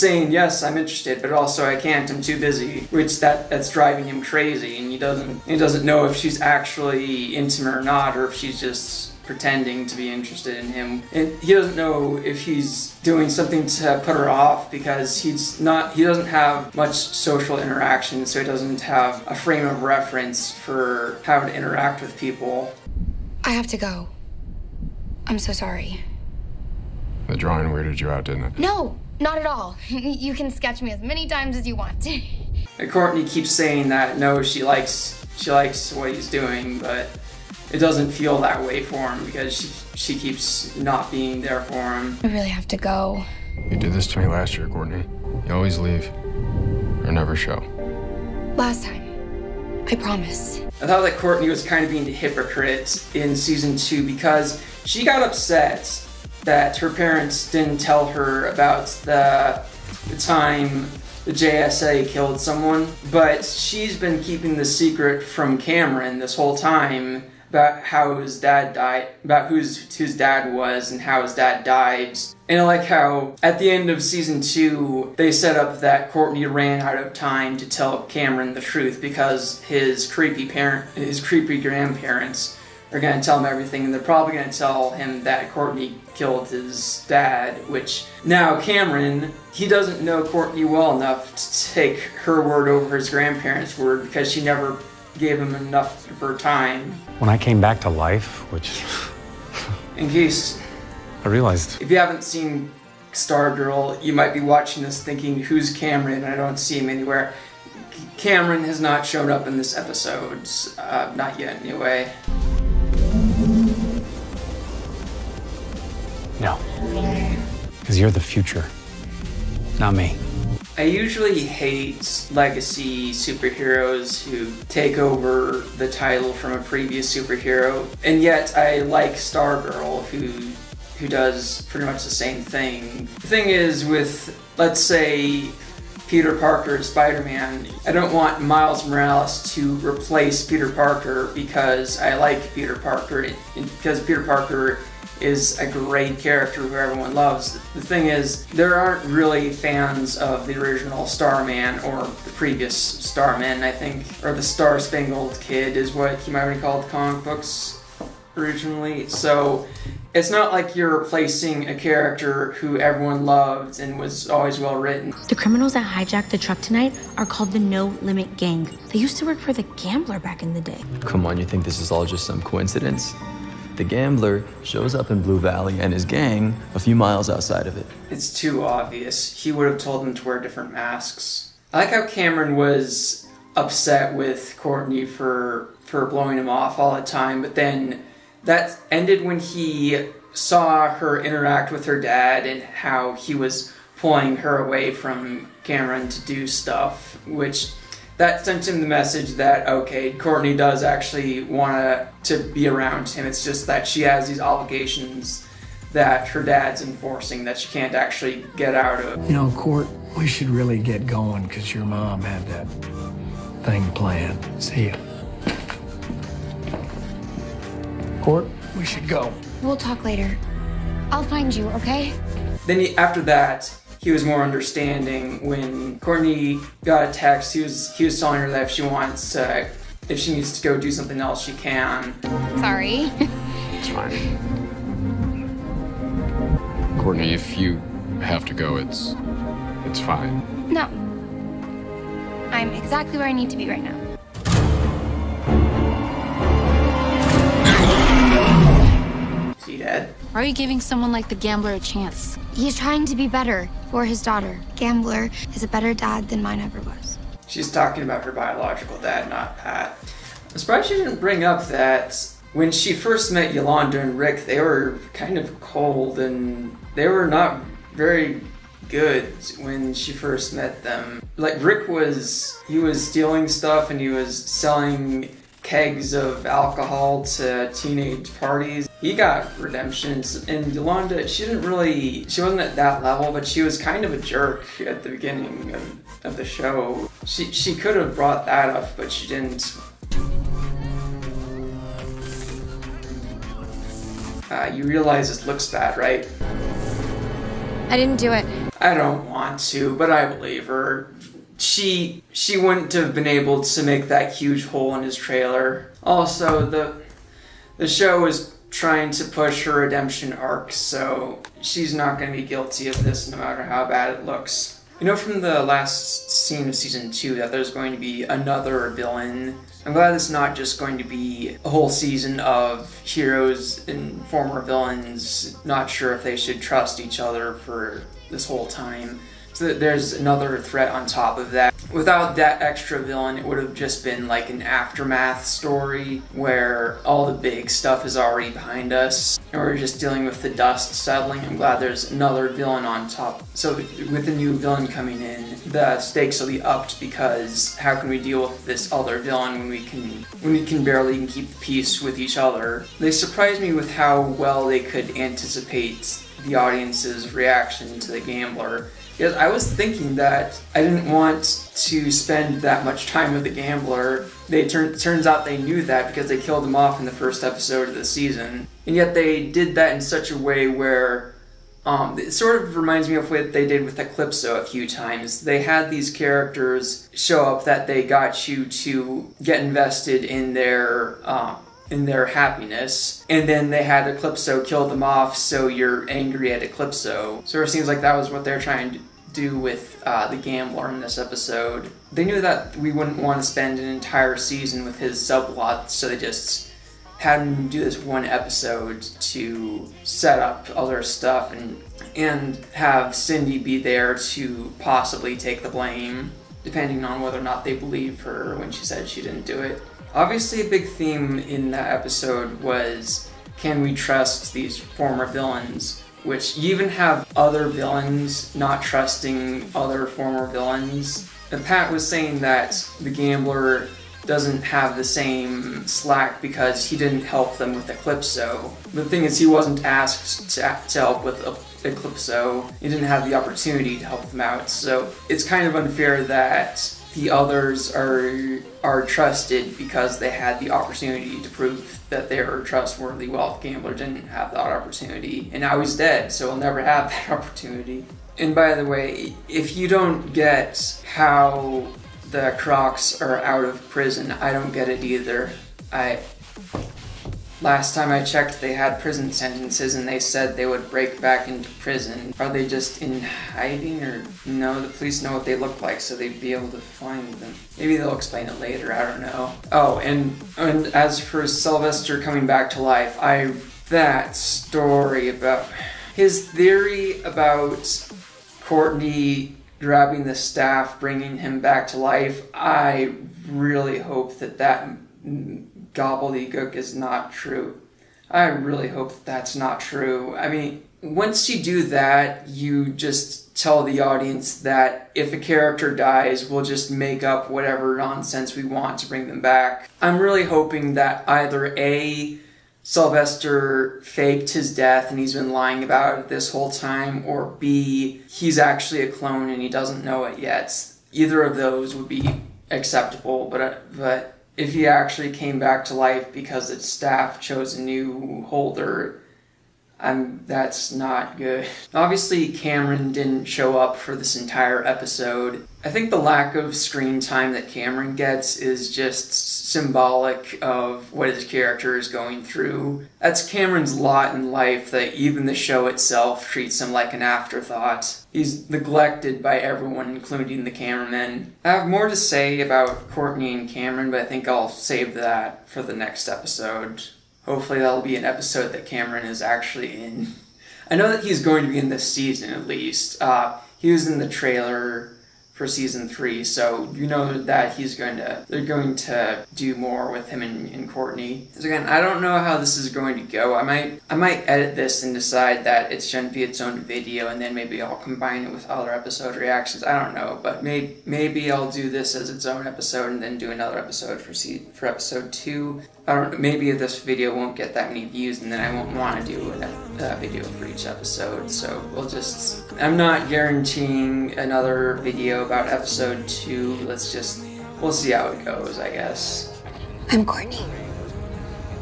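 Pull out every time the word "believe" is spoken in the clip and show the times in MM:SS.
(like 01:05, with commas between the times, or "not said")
05:00, 06:47.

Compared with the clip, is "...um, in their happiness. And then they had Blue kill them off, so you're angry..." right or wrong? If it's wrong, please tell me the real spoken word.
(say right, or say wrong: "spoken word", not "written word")
wrong: "Eclipso", not "Blue".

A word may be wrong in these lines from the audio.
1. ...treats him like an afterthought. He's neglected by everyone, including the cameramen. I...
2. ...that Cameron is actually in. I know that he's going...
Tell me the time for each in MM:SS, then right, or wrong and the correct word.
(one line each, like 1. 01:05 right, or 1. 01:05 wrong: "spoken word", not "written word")
1. 08:56 right
2. 09:08 right.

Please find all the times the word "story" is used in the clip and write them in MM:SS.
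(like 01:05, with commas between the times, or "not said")
05:35, 07:54.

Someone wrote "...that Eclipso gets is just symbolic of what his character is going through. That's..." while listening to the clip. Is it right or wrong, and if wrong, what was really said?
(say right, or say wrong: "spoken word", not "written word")
wrong: "Cameron", not "Eclipso".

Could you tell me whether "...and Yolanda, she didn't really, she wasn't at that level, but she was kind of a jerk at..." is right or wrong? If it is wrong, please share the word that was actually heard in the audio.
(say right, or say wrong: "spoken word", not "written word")
right.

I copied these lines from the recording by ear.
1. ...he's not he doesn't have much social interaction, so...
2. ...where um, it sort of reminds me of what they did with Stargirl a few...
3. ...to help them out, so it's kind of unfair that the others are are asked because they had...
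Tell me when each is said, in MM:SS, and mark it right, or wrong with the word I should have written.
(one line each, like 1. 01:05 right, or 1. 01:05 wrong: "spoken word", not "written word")
1. 00:15 right
2. 06:10 wrong: "Eclipso", not "Stargirl"
3. 07:13 wrong: "trusted", not "asked".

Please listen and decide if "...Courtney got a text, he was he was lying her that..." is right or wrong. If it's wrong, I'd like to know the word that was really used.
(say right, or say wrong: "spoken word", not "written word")
wrong: "telling", not "lying".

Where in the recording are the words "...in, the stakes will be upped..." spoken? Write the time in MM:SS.
05:45.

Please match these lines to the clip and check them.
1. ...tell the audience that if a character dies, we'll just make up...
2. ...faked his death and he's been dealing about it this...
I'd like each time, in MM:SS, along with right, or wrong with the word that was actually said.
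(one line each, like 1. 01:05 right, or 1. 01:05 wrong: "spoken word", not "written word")
1. 08:13 right
2. 08:24 wrong: "lying", not "dealing".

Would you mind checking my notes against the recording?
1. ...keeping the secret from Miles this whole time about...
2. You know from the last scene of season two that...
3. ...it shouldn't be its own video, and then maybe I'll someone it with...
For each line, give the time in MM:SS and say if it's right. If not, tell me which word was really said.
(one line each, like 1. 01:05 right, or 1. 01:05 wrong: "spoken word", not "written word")
1. 01:04 wrong: "Cameron", not "Miles"
2. 05:14 right
3. 09:25 wrong: "combine", not "someone".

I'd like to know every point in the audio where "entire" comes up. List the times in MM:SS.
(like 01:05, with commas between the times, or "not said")
06:33, 08:44.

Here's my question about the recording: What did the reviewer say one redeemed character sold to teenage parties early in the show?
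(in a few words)
kegs of alcohol.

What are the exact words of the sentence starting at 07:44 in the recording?
The police know what they look like, so they'd be able to find them.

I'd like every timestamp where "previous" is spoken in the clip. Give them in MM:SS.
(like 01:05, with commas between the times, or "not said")
02:06, 02:32.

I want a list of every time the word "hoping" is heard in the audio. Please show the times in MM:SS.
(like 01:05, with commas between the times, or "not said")
08:20.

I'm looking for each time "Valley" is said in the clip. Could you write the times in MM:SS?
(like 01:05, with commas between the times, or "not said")
02:55.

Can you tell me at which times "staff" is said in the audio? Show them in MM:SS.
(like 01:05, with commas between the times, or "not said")
08:00, 08:36.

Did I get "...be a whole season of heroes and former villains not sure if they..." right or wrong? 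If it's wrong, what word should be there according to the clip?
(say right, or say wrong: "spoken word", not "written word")
right.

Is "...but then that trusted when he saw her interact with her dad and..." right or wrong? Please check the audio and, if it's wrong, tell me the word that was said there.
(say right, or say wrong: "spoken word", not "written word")
wrong: "ended", not "trusted".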